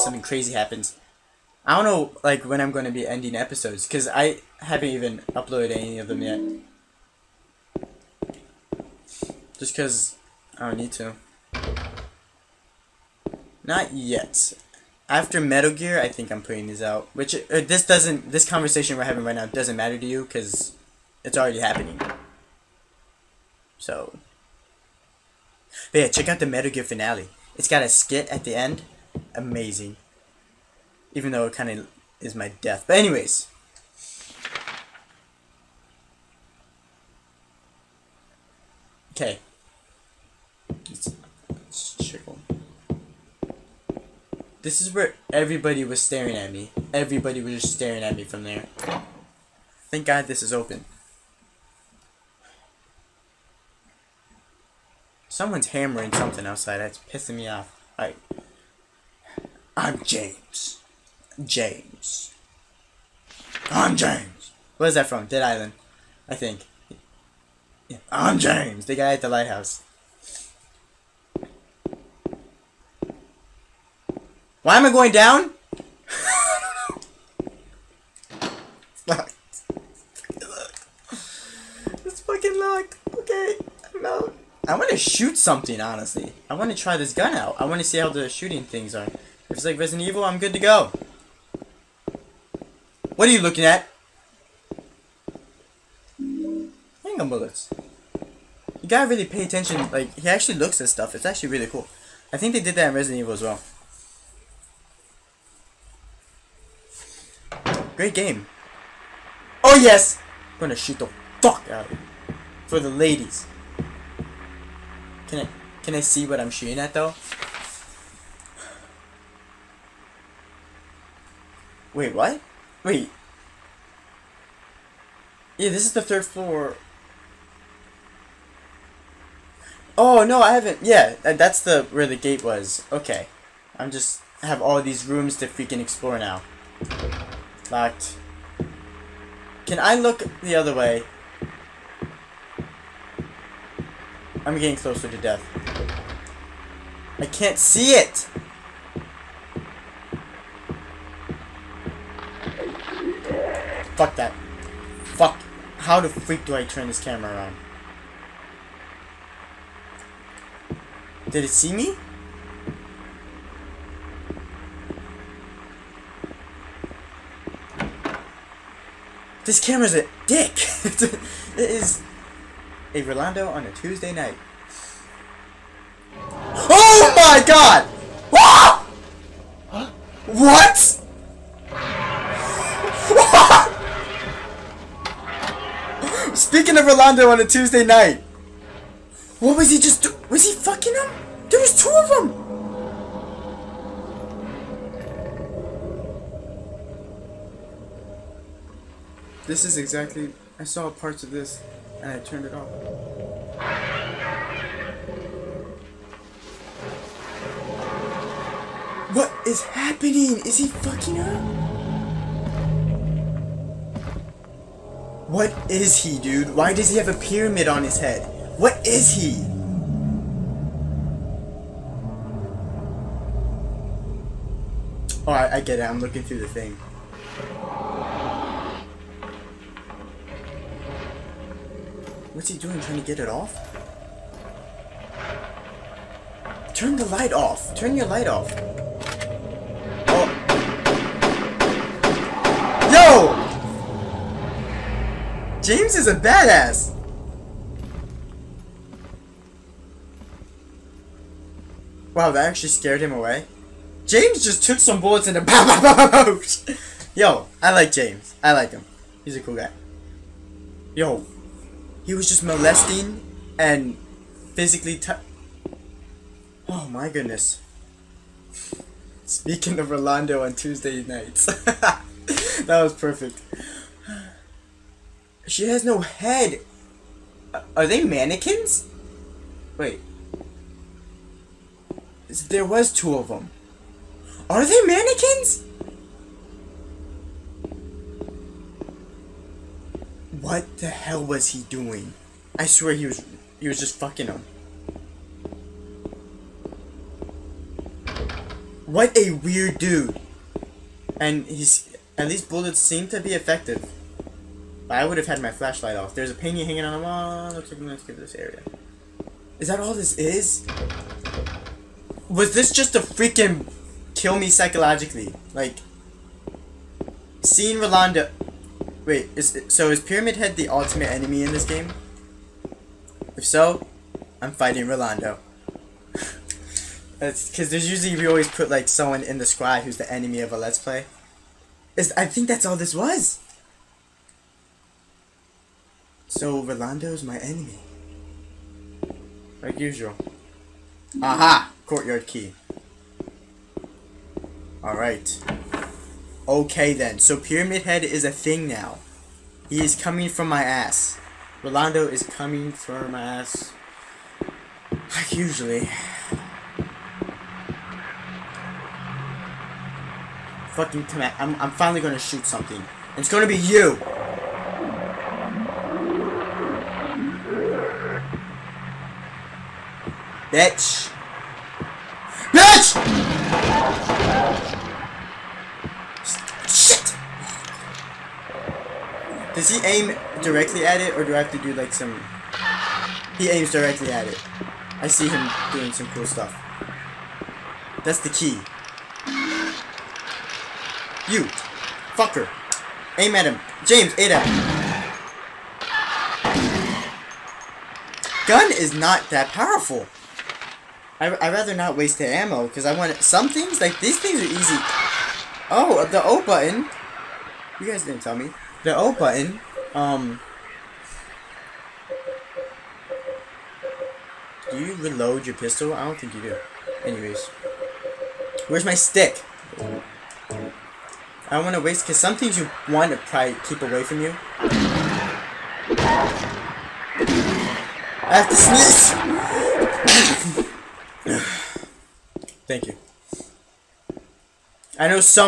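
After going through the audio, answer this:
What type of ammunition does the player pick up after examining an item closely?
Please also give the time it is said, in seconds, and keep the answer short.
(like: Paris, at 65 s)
Handgun bullets, at 97 s.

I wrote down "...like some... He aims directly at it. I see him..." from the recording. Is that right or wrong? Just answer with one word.
right.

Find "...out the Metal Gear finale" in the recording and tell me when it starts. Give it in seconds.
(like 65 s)
26 s.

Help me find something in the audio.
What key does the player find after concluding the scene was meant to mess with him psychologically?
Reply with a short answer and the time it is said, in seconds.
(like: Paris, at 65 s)
Courtyard key, at 341 s.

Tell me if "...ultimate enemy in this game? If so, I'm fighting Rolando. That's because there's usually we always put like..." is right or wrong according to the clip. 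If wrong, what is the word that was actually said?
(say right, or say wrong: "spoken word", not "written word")
right.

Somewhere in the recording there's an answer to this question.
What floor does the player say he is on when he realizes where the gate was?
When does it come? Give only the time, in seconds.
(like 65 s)
126 s.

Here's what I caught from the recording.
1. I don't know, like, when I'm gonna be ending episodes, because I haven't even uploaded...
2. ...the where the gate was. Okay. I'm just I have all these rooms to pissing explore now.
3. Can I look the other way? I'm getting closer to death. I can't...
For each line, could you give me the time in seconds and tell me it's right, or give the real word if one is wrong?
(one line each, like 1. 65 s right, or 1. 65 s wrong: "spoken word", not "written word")
1. 1 s right
2. 131 s wrong: "freaking", not "pissing"
3. 139 s right.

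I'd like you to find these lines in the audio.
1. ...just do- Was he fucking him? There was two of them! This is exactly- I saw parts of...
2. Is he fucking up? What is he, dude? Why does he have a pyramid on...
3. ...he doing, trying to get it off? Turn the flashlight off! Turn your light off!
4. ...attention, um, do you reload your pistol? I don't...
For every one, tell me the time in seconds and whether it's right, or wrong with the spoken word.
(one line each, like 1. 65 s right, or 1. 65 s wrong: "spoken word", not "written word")
1. 189 s right
2. 210 s right
3. 232 s wrong: "light", not "flashlight"
4. 409 s wrong: "button", not "attention".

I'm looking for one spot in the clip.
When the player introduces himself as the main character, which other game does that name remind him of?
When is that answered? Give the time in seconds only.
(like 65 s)
65 s.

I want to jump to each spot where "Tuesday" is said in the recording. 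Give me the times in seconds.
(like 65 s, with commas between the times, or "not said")
173 s, 187 s, 270 s.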